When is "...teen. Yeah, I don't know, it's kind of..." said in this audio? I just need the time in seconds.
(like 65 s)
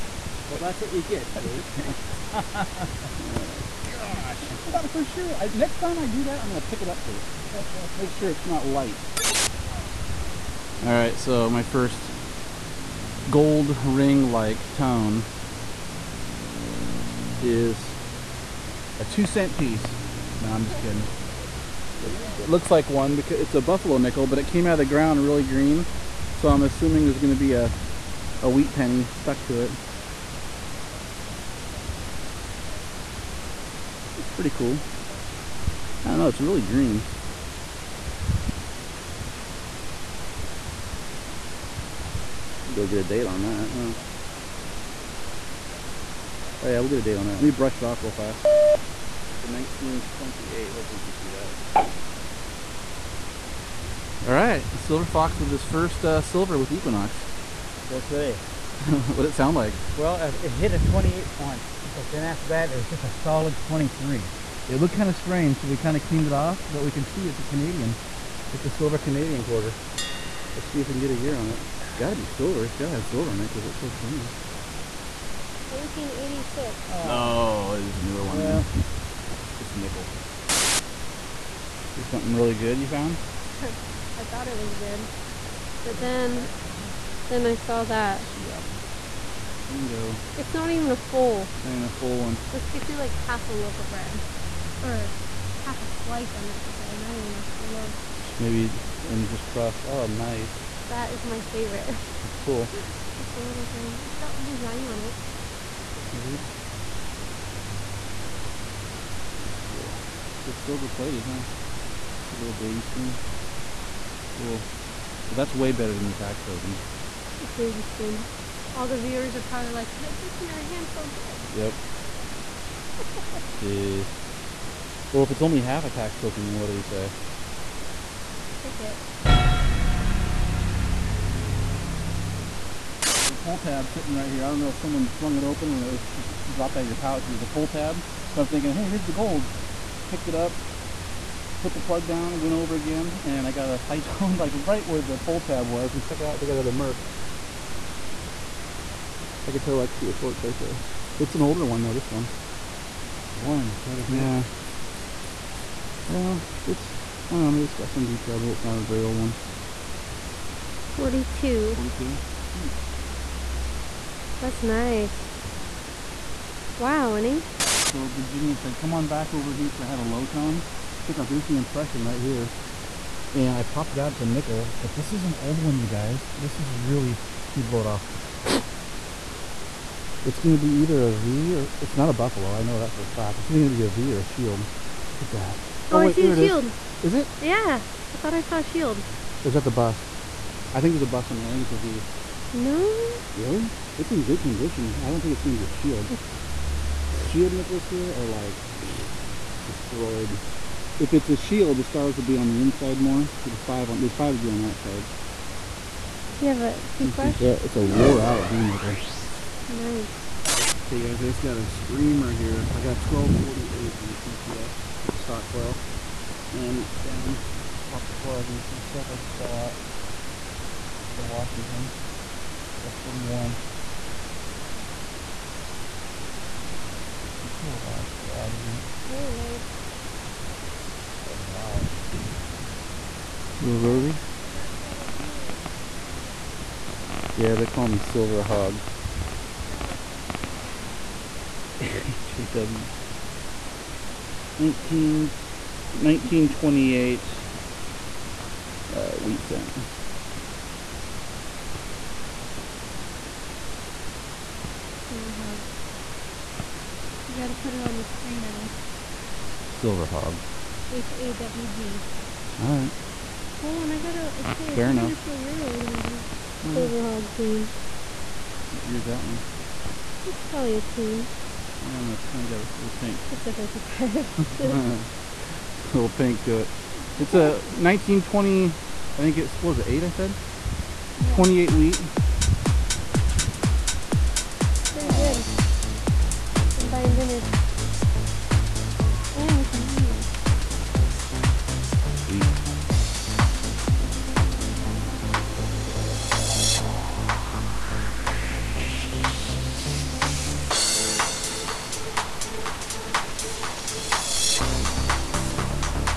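270 s.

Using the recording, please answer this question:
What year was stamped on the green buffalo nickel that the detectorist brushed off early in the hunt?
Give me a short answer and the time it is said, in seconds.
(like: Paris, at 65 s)
1928, at 49 s.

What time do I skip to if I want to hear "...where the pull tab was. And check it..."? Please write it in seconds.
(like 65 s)
144 s.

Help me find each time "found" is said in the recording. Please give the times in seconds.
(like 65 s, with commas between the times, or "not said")
82 s.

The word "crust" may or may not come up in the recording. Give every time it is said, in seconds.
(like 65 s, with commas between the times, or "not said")
99 s.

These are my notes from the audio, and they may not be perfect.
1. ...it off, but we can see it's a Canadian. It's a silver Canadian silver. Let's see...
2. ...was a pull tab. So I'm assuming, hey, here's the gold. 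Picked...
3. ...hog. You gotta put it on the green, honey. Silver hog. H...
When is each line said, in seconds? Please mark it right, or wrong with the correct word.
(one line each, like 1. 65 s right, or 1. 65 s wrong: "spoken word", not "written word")
1. 66 s wrong: "quarter", not "silver"
2. 137 s wrong: "thinking", not "assuming"
3. 255 s wrong: "screen", not "green".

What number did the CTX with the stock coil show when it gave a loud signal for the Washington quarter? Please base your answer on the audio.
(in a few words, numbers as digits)
1248.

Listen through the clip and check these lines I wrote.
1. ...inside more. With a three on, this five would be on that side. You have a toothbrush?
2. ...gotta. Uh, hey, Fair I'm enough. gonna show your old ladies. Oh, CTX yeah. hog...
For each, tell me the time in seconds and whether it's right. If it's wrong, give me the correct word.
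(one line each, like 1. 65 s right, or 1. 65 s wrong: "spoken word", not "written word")
1. 202 s wrong: "five", not "three"
2. 263 s wrong: "Silver", not "CTX".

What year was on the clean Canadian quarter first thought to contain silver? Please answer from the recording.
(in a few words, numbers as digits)
1986.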